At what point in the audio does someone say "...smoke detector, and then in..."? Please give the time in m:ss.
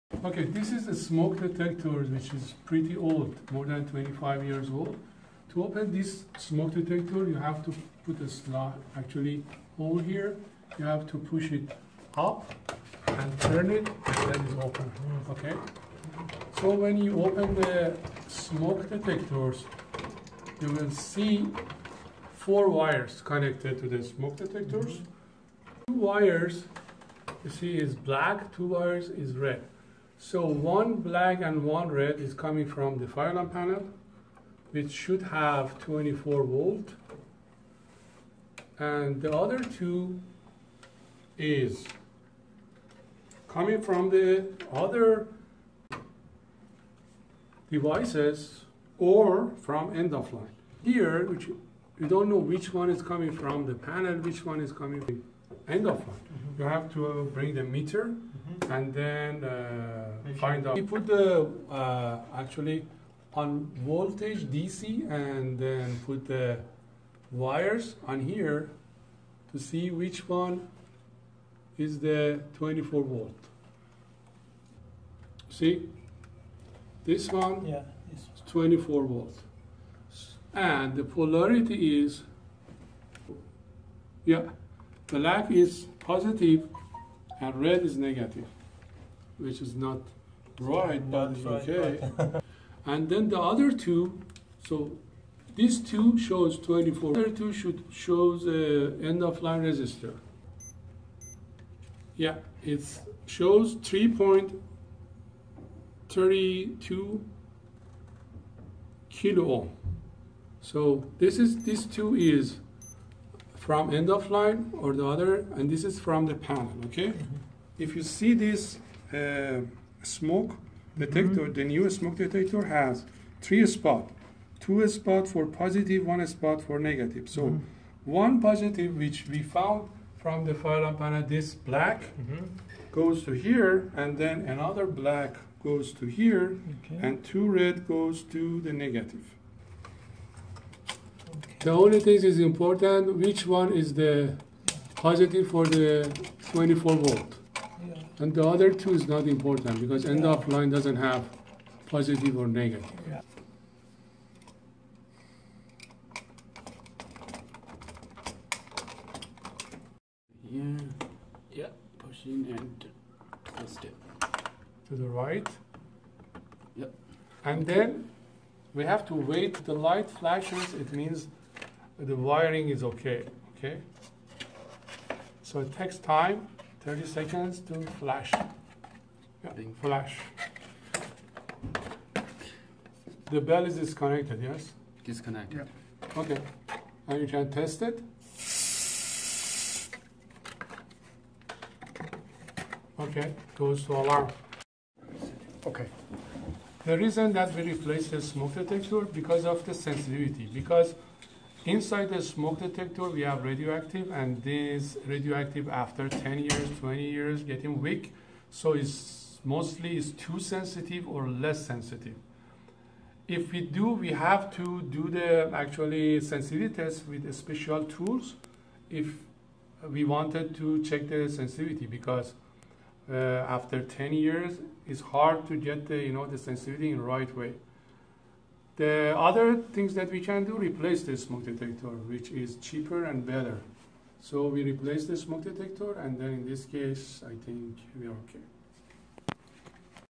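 3:55.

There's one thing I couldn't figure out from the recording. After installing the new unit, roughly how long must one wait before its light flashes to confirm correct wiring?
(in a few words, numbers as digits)
30 seconds.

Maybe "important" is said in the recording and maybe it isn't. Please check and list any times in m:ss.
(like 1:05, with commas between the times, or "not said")
2:22, 2:29.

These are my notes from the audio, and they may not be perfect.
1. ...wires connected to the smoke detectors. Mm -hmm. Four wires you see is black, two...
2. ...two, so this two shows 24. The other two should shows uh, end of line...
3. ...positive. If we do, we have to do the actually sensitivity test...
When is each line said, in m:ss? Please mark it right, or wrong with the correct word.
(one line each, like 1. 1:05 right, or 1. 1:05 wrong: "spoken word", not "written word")
1. 0:22 wrong: "Two", not "Four"
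2. 1:33 right
3. 3:31 wrong: "sensitive", not "positive".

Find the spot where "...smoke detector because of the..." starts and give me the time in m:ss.
3:18.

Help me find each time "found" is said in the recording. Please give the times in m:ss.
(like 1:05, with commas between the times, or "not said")
2:09.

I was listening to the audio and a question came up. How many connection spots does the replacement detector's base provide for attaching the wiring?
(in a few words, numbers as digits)
3.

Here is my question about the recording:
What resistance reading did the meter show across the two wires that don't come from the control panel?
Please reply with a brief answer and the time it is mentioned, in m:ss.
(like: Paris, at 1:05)
3.32 kilo ohm, at 1:43.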